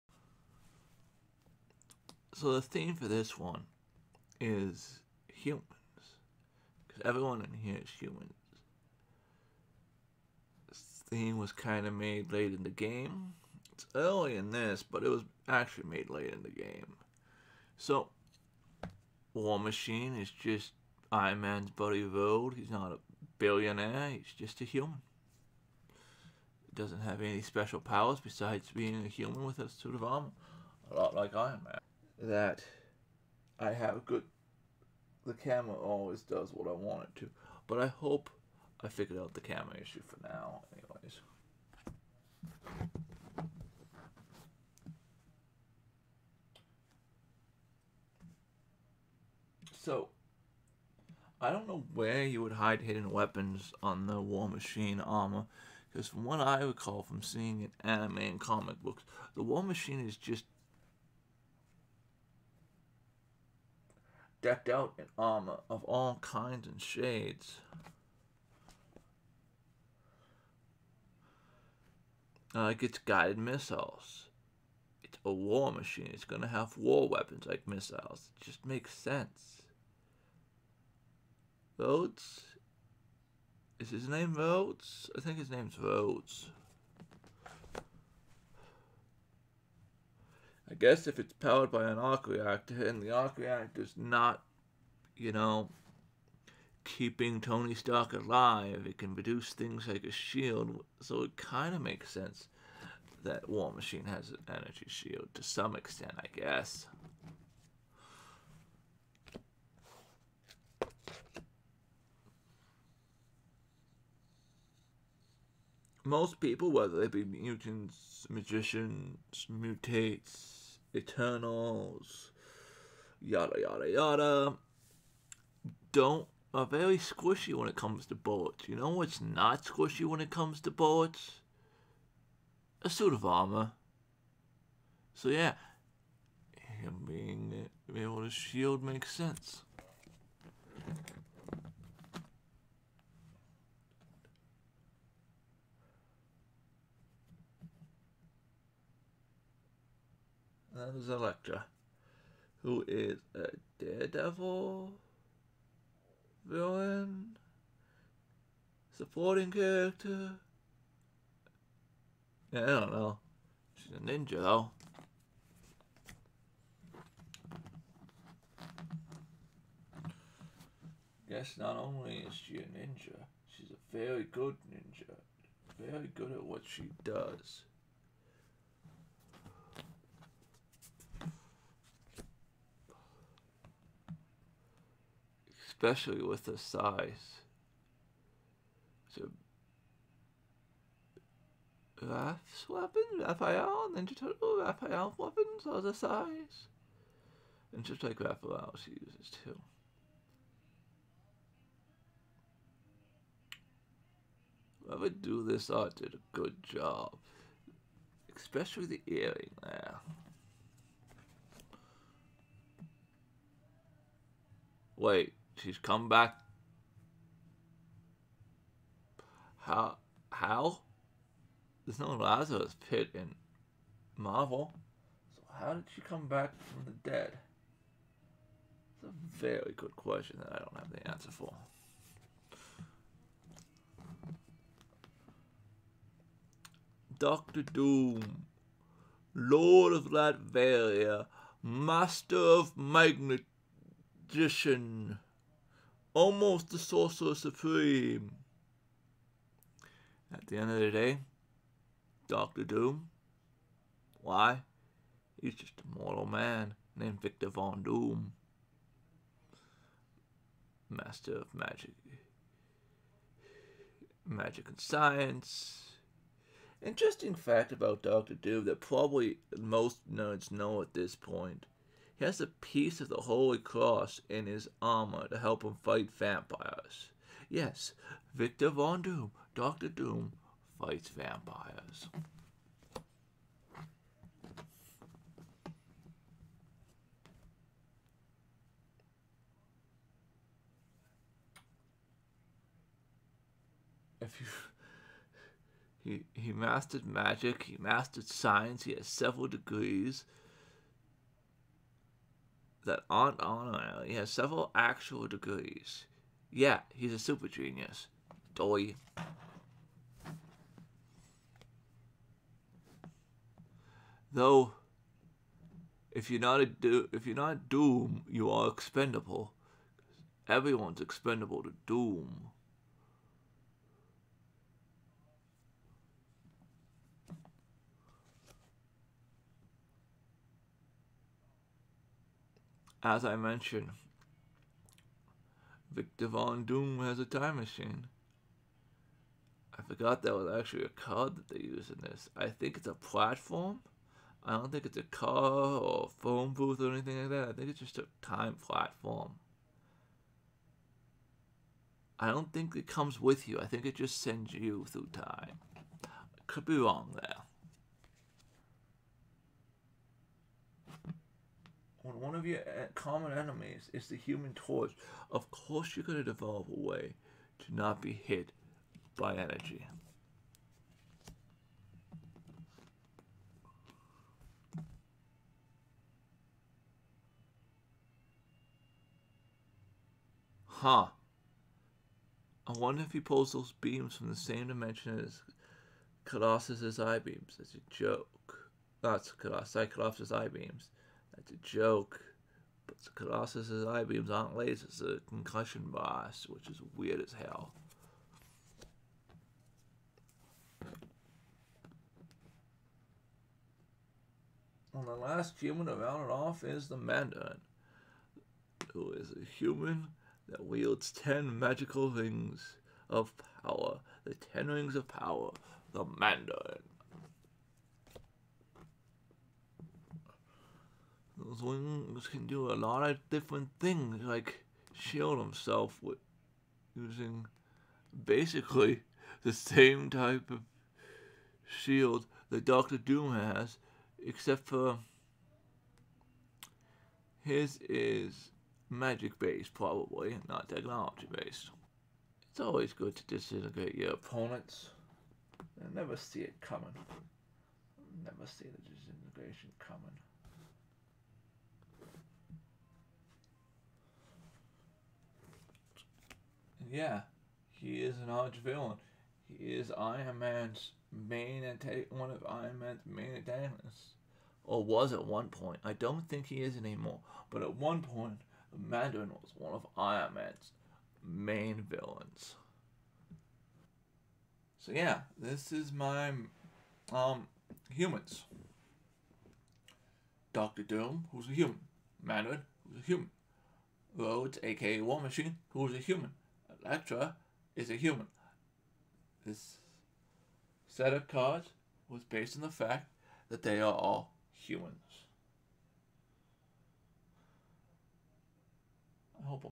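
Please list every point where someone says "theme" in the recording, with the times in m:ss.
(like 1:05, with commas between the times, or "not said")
0:02, 0:11.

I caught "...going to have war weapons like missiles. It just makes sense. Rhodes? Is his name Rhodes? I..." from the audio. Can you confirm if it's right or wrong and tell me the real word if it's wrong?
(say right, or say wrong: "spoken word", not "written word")
right.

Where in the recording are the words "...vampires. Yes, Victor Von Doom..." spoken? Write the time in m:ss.
4:36.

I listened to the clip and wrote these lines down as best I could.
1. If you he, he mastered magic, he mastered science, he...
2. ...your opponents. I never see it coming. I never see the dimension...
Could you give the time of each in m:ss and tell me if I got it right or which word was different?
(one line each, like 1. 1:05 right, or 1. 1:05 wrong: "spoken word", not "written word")
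1. 4:54 right
2. 7:23 wrong: "disintegration", not "dimension".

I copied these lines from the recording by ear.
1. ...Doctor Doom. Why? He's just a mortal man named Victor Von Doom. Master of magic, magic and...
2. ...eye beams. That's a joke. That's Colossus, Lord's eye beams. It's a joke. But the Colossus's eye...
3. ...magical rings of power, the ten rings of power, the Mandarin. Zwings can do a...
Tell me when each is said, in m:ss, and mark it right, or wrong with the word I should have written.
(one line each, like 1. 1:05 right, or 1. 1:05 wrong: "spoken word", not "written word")
1. 4:12 right
2. 6:26 wrong: "Colossus", not "Lord"
3. 6:51 right.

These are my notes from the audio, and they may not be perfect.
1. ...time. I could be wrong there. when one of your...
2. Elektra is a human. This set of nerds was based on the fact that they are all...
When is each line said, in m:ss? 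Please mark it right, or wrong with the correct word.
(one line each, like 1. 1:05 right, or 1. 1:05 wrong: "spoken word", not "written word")
1. 5:55 right
2. 8:06 wrong: "cards", not "nerds".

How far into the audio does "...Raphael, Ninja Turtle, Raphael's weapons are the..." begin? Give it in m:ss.
3:13.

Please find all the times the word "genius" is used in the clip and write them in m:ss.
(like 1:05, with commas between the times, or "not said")
5:07.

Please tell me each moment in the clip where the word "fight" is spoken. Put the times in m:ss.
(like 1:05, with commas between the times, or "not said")
4:35, 4:40.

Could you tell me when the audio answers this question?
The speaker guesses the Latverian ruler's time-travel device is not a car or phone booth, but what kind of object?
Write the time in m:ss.
5:48.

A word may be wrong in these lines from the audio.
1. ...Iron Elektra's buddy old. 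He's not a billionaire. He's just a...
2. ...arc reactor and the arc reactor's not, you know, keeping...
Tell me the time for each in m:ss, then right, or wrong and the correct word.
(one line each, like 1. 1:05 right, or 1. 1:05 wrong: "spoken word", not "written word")
1. 0:21 wrong: "Man", not "Elektra"
2. 1:31 right.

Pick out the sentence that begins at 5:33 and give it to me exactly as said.
as I mentioned, Victor Von Doom has a time machine.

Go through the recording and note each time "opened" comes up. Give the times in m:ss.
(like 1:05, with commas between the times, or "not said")
not said.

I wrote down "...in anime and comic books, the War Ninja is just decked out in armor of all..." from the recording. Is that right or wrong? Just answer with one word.
wrong.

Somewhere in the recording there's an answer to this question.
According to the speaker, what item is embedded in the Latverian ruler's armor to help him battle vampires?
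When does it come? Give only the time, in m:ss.
4:32.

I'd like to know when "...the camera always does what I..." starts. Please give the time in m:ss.
0:35.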